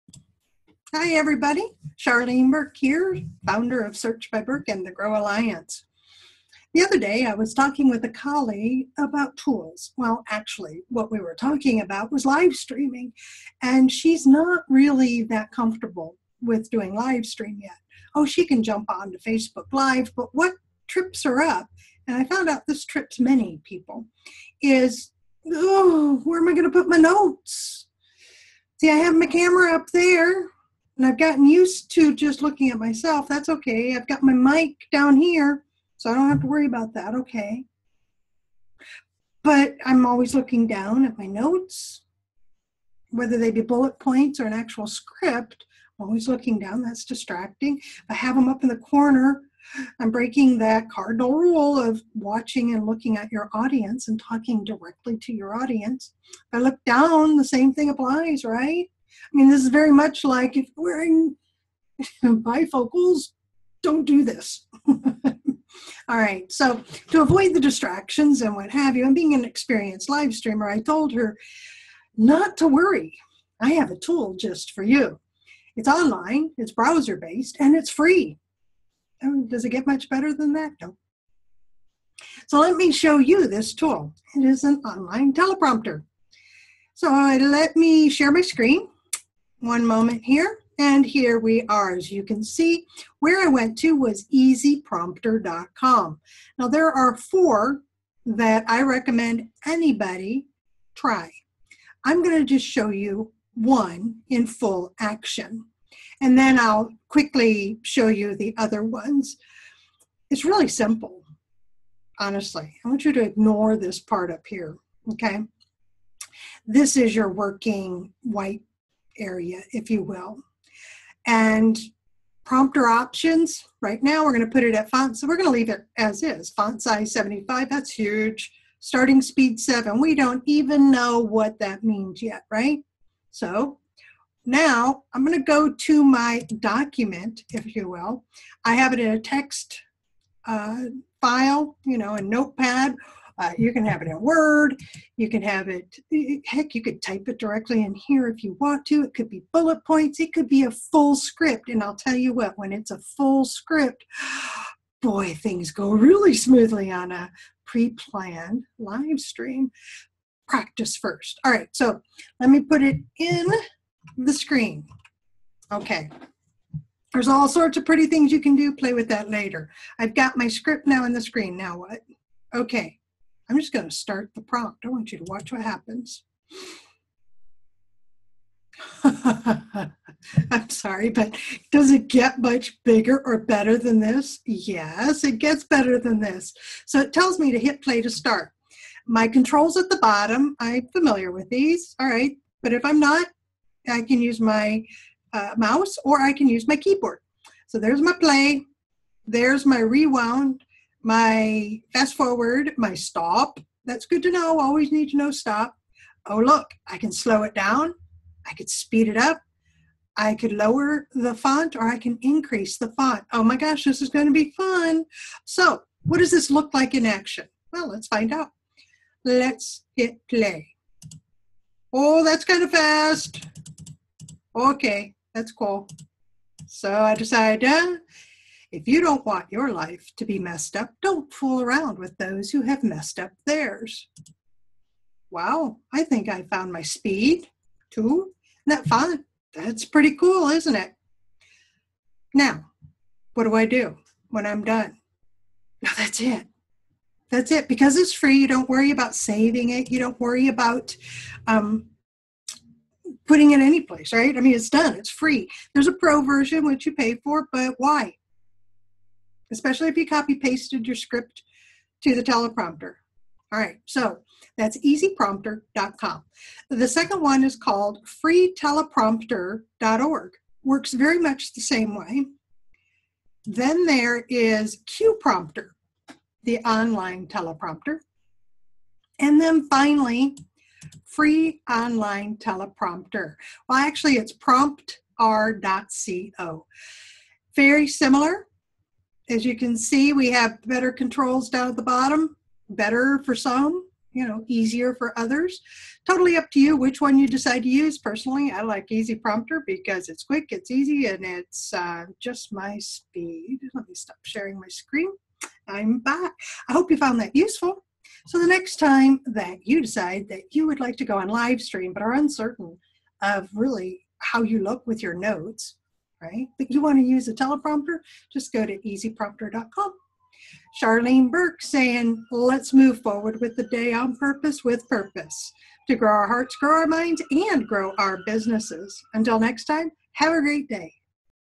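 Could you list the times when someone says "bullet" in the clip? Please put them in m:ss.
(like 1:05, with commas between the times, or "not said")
0:43, 2:29.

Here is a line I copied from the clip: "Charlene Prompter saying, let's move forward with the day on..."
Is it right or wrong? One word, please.
wrong.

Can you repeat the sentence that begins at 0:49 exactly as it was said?
I'm breaking that cardinal rule of watching and looking at your audience and talking directly to your audience.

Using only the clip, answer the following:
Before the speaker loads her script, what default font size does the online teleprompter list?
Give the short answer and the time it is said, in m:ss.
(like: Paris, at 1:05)
75, at 2:07.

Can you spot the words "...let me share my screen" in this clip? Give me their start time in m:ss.
1:27.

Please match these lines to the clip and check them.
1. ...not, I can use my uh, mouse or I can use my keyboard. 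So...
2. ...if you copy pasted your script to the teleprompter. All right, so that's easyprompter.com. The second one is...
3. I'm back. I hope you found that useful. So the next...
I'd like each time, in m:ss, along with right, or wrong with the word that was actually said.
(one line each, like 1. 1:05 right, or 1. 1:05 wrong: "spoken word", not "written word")
1. 3:13 right
2. 4:19 right
3. 5:05 right.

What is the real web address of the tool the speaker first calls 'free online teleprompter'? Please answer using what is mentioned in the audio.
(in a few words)
promptr.co.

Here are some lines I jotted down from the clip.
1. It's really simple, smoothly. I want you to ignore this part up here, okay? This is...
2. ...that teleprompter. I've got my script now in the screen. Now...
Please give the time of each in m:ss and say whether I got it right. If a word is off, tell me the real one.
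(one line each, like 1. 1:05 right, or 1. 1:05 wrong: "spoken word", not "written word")
1. 1:50 wrong: "honestly", not "smoothly"
2. 2:49 wrong: "later", not "teleprompter".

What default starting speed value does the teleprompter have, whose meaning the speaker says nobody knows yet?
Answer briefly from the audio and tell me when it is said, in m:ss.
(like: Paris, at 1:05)
7, at 2:09.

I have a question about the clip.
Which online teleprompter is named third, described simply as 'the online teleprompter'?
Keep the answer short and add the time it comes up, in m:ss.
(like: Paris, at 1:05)
CuePrompter, at 4:34.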